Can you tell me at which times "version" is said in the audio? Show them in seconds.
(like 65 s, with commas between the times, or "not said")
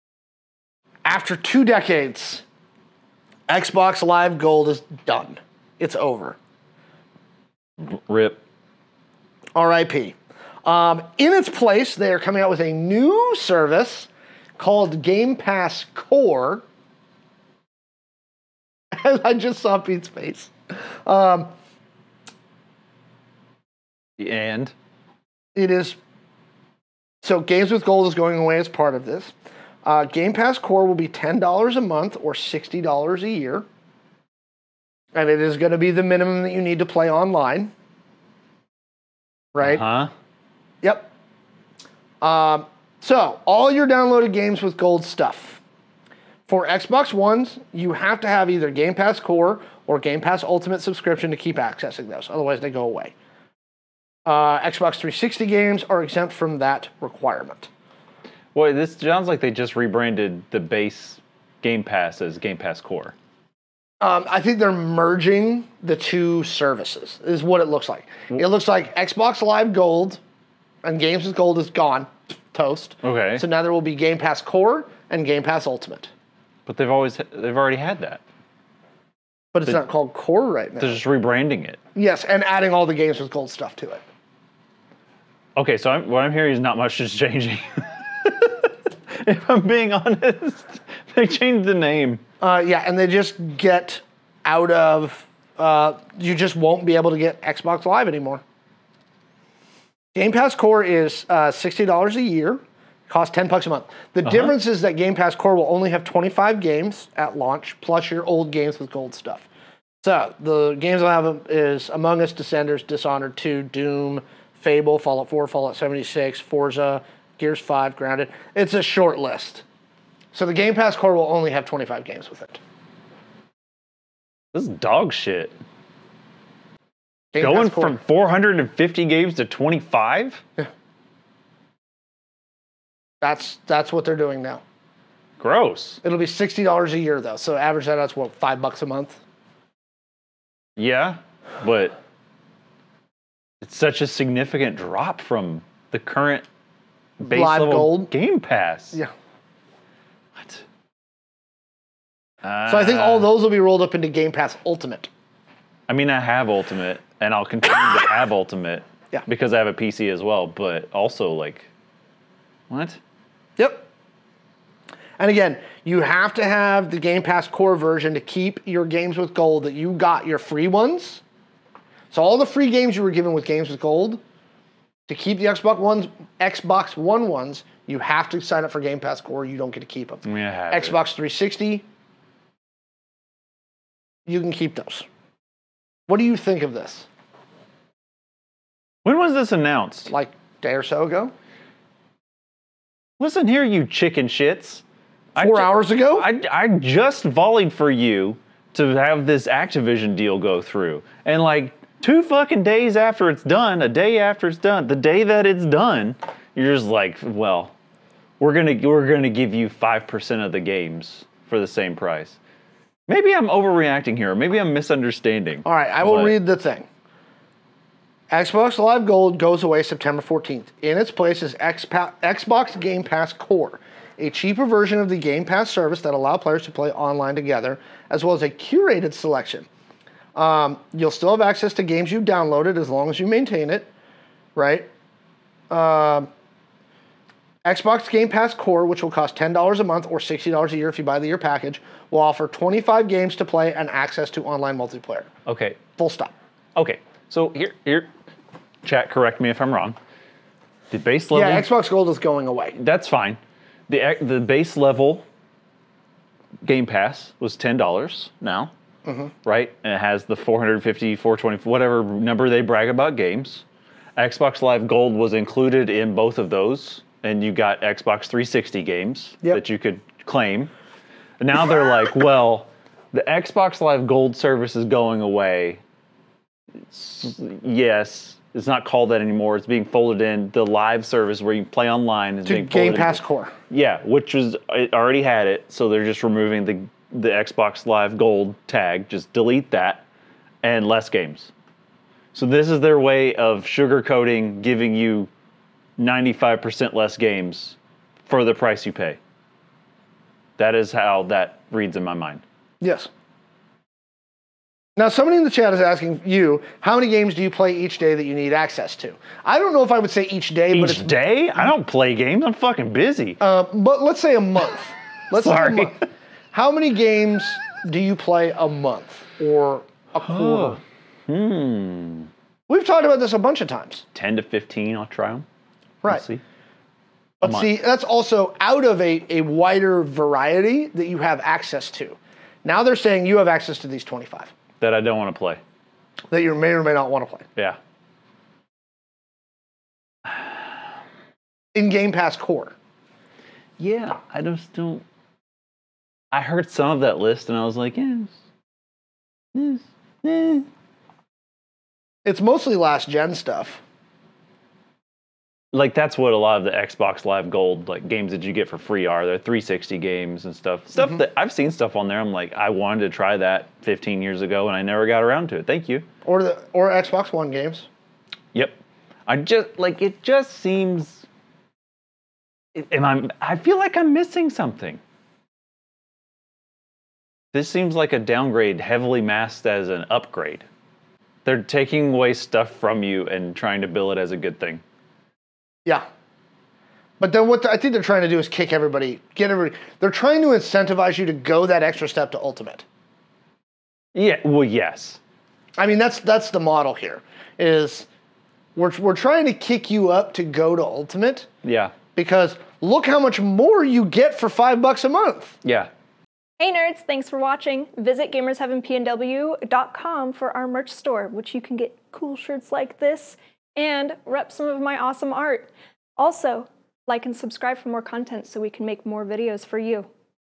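167 s, 224 s.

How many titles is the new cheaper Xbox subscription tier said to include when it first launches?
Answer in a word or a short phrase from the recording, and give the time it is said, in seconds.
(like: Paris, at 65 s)
25, at 106 s.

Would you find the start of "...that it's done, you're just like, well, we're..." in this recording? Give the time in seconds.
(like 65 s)
205 s.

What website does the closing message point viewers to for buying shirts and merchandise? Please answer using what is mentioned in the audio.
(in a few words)
gamersheavenpnw.com.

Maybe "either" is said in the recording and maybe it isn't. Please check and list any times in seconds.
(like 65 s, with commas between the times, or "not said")
48 s.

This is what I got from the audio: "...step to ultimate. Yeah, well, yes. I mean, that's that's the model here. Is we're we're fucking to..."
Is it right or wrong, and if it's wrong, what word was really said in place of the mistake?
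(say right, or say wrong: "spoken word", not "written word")
wrong: "trying", not "fucking".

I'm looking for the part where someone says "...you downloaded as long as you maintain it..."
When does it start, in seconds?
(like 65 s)
232 s.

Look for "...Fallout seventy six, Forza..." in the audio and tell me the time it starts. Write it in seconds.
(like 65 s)
115 s.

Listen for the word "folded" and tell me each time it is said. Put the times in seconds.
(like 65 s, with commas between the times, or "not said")
279 s.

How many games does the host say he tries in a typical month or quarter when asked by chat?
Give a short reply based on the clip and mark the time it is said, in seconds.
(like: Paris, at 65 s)
10 to 15, at 324 s.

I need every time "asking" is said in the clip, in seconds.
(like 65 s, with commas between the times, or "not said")
305 s.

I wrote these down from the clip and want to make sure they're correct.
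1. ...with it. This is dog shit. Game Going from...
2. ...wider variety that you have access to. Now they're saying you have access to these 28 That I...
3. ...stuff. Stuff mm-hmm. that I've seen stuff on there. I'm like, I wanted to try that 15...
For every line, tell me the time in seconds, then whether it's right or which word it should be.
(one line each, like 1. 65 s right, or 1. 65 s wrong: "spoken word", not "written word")
1. 122 s right
2. 329 s wrong: "25", not "28"
3. 360 s right.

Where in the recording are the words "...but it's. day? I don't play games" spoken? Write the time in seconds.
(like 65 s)
310 s.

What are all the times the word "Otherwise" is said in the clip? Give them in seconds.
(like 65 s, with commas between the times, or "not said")
52 s.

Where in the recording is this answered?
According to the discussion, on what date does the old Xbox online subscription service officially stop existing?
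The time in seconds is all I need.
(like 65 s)
219 s.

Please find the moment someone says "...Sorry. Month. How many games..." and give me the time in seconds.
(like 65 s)
315 s.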